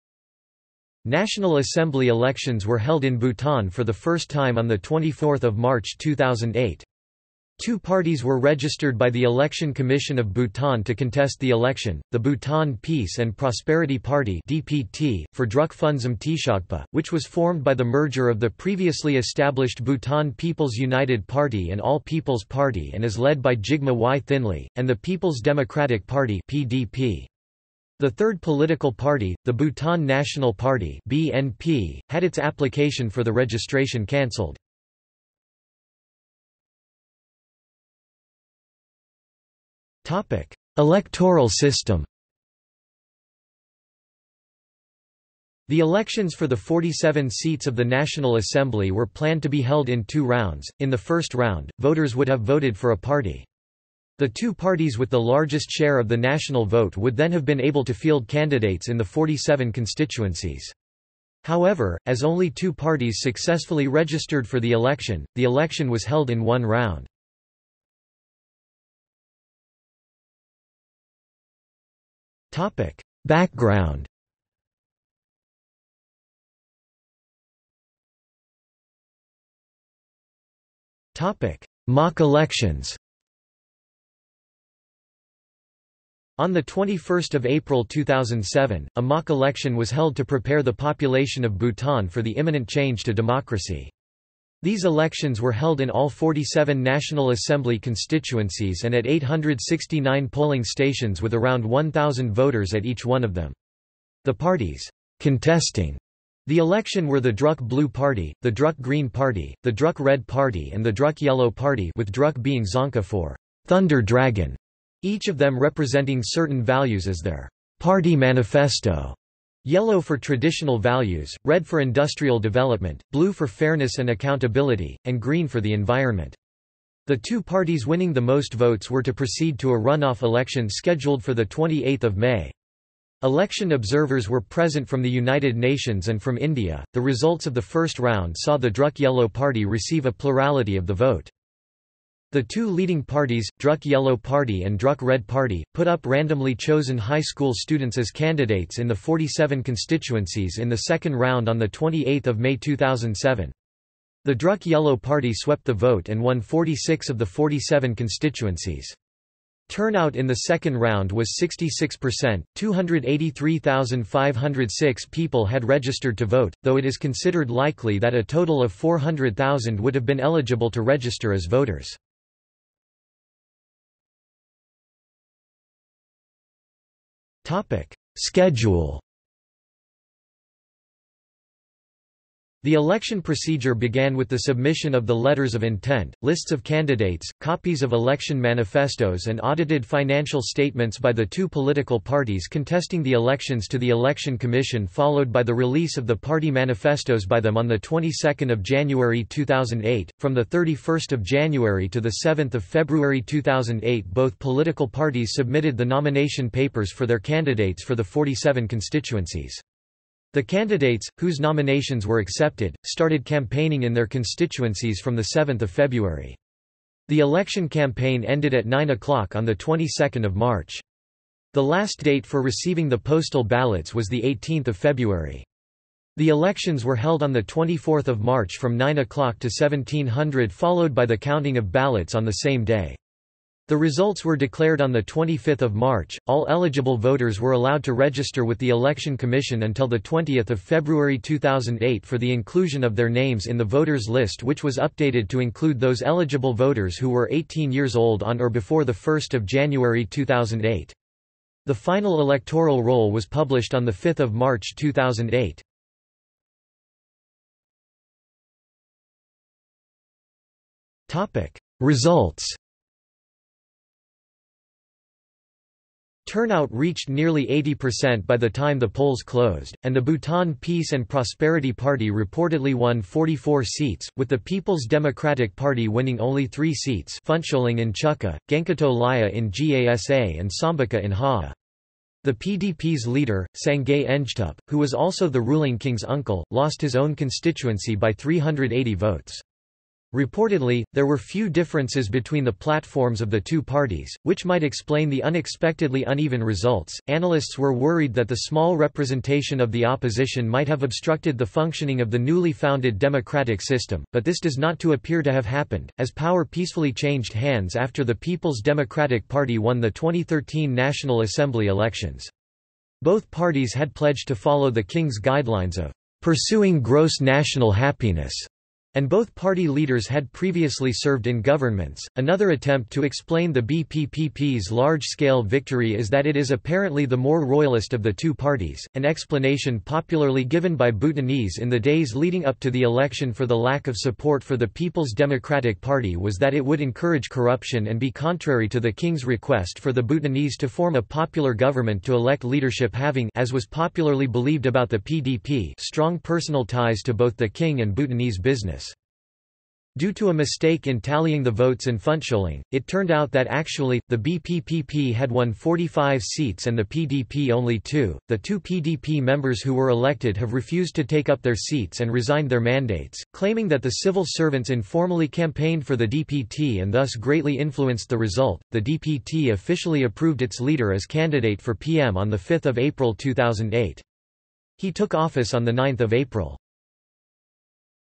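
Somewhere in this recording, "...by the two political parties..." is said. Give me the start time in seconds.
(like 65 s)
190 s.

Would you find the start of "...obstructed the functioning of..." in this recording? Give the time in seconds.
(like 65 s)
300 s.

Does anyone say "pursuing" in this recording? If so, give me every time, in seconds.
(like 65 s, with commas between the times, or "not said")
316 s.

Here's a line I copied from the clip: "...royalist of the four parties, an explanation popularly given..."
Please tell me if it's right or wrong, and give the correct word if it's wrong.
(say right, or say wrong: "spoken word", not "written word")
wrong: "two", not "four".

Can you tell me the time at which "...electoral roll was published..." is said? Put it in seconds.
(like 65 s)
252 s.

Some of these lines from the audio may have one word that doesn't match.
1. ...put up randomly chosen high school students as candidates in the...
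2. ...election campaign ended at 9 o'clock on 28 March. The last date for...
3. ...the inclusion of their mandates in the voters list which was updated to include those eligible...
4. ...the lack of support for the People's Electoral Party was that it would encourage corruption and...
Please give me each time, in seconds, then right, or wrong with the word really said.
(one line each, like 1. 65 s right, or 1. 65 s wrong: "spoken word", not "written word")
1. 145 s right
2. 217 s wrong: "22", not "28"
3. 242 s wrong: "names", not "mandates"
4. 333 s wrong: "Democratic", not "Electoral".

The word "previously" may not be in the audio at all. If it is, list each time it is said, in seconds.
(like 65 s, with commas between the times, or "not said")
18 s, 320 s.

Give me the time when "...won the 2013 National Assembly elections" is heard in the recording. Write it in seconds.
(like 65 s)
309 s.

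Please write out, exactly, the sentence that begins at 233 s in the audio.
The results were declared on 25 March.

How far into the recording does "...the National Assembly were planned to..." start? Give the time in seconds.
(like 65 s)
47 s.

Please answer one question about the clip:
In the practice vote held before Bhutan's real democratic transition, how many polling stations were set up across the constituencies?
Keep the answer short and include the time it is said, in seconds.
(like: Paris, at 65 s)
869, at 99 s.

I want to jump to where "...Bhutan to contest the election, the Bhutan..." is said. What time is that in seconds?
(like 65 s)
10 s.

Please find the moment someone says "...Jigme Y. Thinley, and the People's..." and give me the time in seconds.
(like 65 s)
23 s.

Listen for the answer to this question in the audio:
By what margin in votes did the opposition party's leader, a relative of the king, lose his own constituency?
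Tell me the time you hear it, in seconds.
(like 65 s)
288 s.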